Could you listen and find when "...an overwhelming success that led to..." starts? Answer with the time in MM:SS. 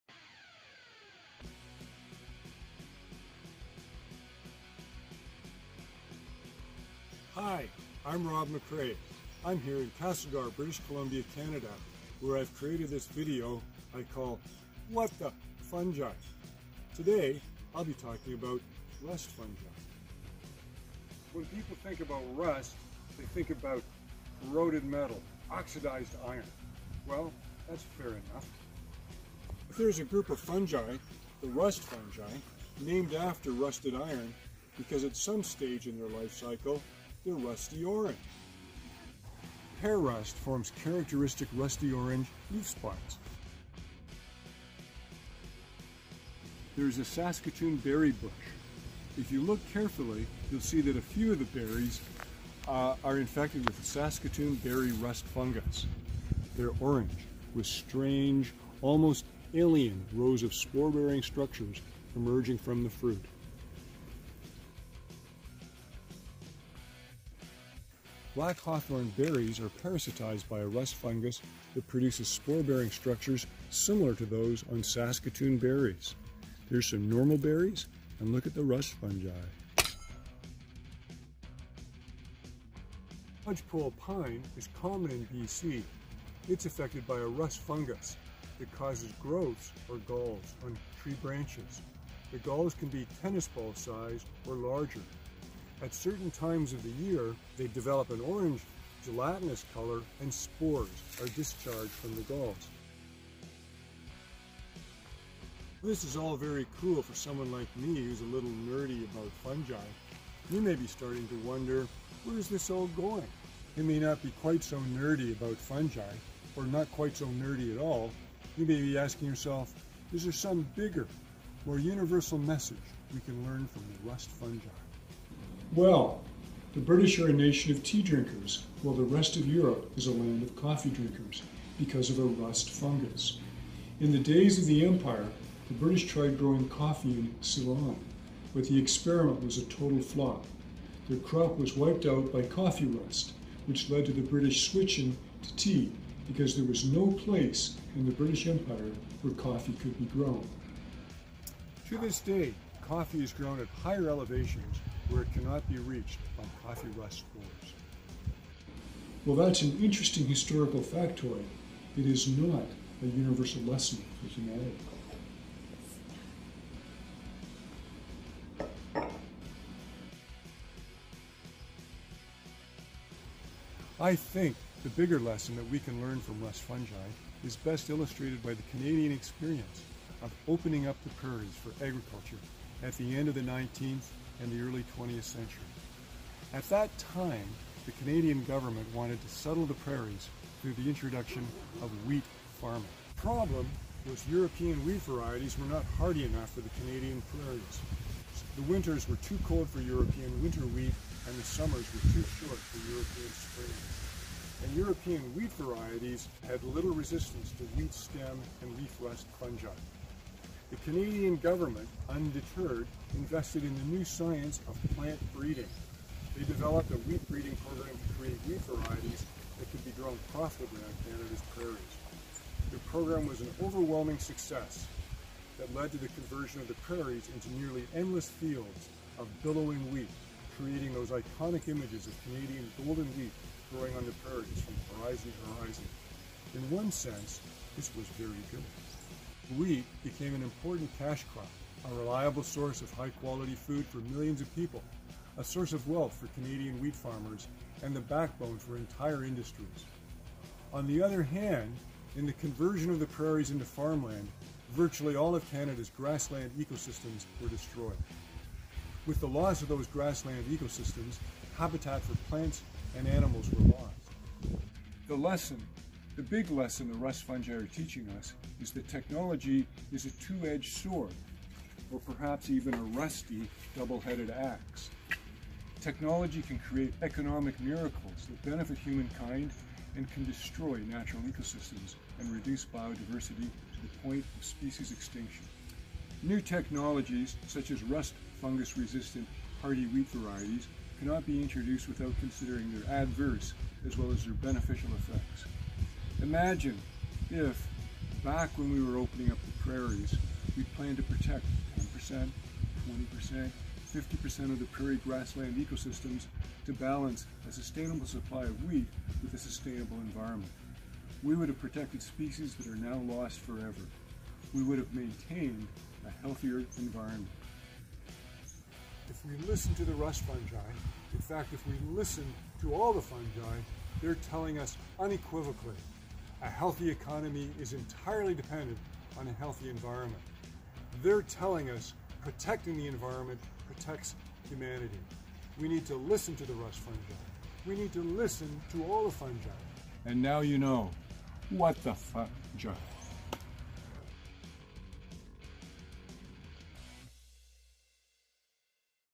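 03:43.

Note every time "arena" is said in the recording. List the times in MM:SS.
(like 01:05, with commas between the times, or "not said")
not said.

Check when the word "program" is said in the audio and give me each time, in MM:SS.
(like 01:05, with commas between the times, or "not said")
03:37, 03:42.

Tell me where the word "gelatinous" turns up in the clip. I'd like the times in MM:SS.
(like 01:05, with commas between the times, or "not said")
01:39.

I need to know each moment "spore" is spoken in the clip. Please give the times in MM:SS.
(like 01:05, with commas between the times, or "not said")
01:00, 01:12, 01:40.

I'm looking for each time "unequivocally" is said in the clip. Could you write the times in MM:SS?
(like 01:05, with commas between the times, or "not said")
05:24.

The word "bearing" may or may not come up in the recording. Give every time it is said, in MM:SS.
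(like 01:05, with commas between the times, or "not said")
01:00, 01:12.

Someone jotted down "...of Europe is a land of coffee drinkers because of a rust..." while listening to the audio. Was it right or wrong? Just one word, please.
right.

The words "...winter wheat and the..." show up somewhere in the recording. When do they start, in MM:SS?
03:20.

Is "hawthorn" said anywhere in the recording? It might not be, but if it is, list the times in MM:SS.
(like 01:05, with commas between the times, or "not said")
01:08.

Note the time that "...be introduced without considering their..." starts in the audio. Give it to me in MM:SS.
04:51.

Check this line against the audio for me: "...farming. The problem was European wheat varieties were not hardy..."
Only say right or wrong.
right.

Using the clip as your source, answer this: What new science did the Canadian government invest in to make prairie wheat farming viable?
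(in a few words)
Plant breeding.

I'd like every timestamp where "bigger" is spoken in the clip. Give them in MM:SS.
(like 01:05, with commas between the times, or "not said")
02:00, 02:54.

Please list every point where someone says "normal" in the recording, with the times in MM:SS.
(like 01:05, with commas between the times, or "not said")
01:17.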